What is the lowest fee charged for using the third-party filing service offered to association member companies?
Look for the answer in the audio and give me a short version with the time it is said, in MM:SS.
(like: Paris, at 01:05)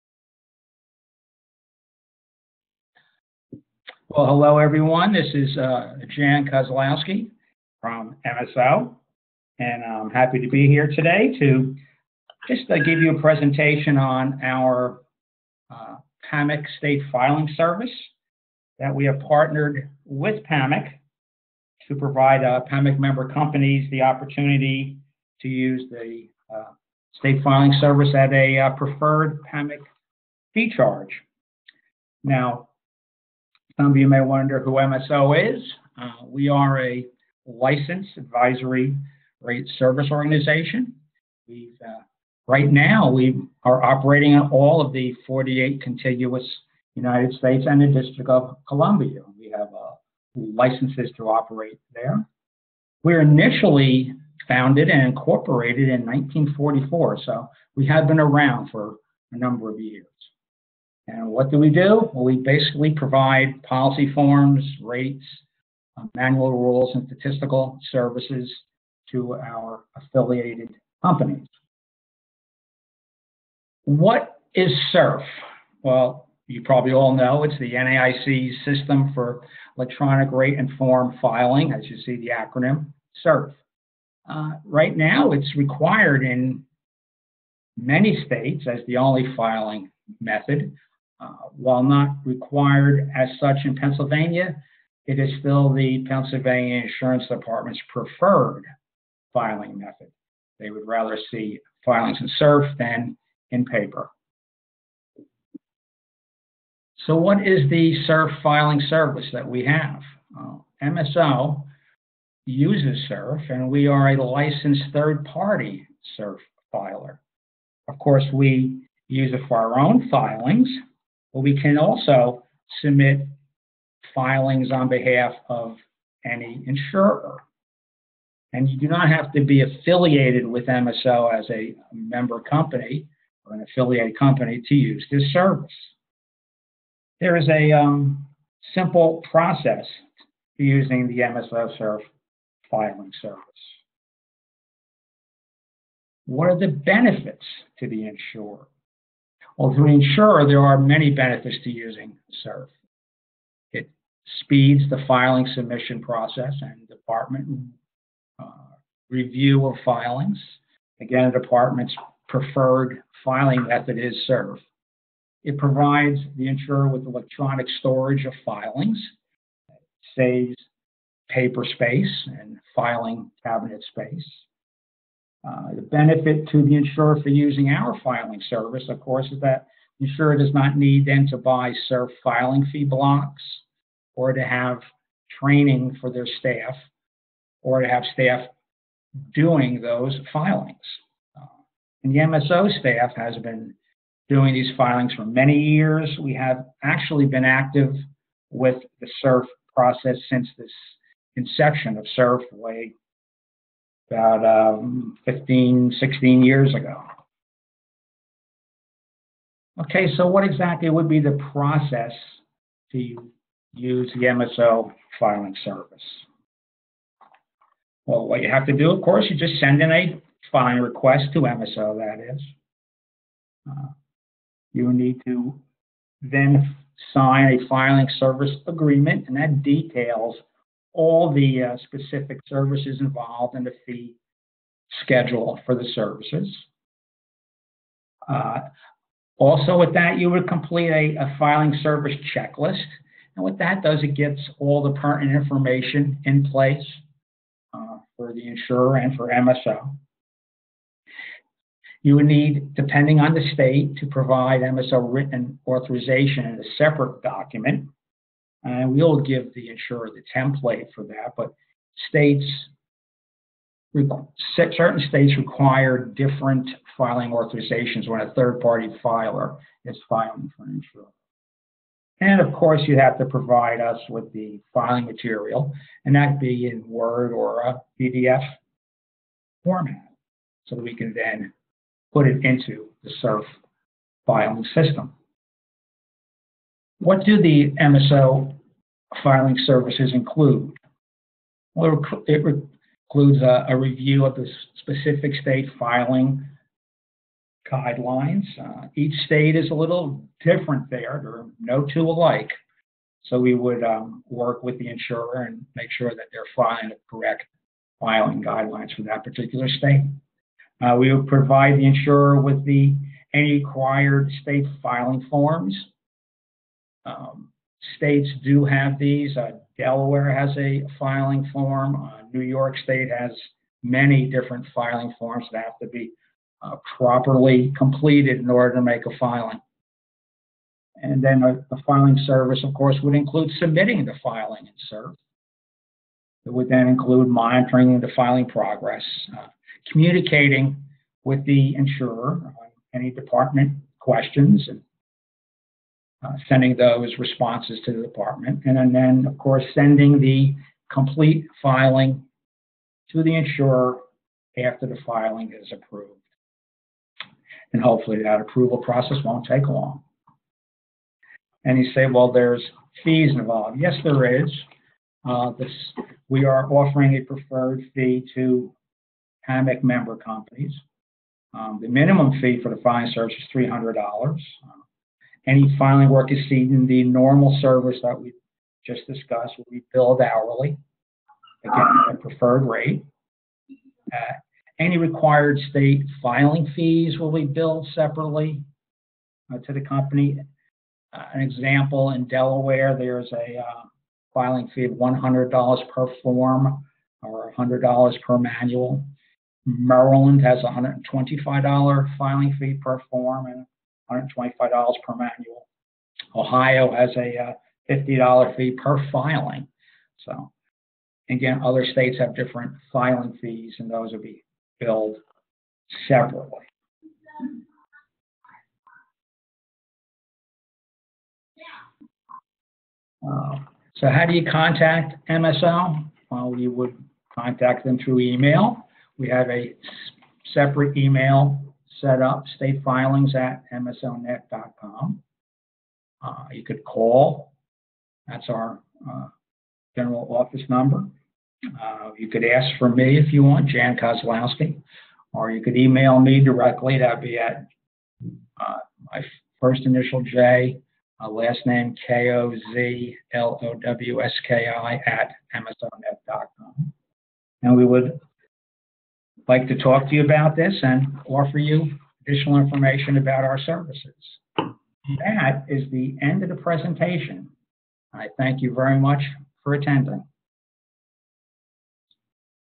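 $300, at 06:13.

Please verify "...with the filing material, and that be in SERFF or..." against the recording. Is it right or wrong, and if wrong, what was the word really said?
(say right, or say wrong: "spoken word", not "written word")
wrong: "Word", not "SERFF".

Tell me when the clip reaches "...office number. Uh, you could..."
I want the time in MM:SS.
07:20.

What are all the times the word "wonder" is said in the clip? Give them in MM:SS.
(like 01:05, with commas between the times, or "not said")
00:34.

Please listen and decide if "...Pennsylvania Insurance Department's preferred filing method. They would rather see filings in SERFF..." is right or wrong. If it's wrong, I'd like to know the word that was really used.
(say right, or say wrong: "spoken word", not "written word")
right.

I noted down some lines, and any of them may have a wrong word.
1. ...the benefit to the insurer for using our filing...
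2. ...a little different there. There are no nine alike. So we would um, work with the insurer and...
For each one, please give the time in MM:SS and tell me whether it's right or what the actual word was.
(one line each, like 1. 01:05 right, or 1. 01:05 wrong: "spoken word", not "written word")
1. 02:55 right
2. 04:59 wrong: "two", not "nine".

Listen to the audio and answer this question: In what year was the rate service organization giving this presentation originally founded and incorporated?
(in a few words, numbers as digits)
1944.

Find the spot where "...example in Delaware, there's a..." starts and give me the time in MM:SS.
06:31.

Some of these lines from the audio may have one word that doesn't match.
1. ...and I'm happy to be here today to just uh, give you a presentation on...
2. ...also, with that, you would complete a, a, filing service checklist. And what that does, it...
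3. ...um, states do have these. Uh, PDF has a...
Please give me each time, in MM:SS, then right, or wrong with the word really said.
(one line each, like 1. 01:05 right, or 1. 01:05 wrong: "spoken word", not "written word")
1. 00:09 right
2. 03:59 right
3. 05:17 wrong: "Delaware", not "PDF".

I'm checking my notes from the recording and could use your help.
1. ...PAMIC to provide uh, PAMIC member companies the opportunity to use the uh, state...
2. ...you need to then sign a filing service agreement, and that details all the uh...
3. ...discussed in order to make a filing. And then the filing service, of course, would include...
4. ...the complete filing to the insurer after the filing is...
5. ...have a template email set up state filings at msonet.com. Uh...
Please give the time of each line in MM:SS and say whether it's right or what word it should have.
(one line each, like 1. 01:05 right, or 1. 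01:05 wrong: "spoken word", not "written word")
1. 00:20 right
2. 03:44 right
3. 05:27 wrong: "completed", not "discussed"
4. 05:50 right
5. 07:09 wrong: "separate", not "template".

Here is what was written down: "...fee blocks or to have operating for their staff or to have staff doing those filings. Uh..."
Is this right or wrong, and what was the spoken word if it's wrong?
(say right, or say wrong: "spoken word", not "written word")
wrong: "training", not "operating".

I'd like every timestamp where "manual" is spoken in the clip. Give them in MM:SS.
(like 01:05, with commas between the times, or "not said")
01:06, 06:38, 06:45.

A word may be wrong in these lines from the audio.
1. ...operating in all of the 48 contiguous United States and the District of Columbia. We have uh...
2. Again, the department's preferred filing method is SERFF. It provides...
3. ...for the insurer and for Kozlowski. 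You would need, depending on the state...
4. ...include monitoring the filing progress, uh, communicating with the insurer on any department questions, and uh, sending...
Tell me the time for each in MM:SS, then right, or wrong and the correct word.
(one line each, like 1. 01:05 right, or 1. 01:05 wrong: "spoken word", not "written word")
1. 00:43 right
2. 02:41 right
3. 04:08 wrong: "MSO", not "Kozlowski"
4. 05:36 right.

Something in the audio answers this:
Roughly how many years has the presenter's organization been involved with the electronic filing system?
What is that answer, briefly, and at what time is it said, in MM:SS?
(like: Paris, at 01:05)
15, at 03:25.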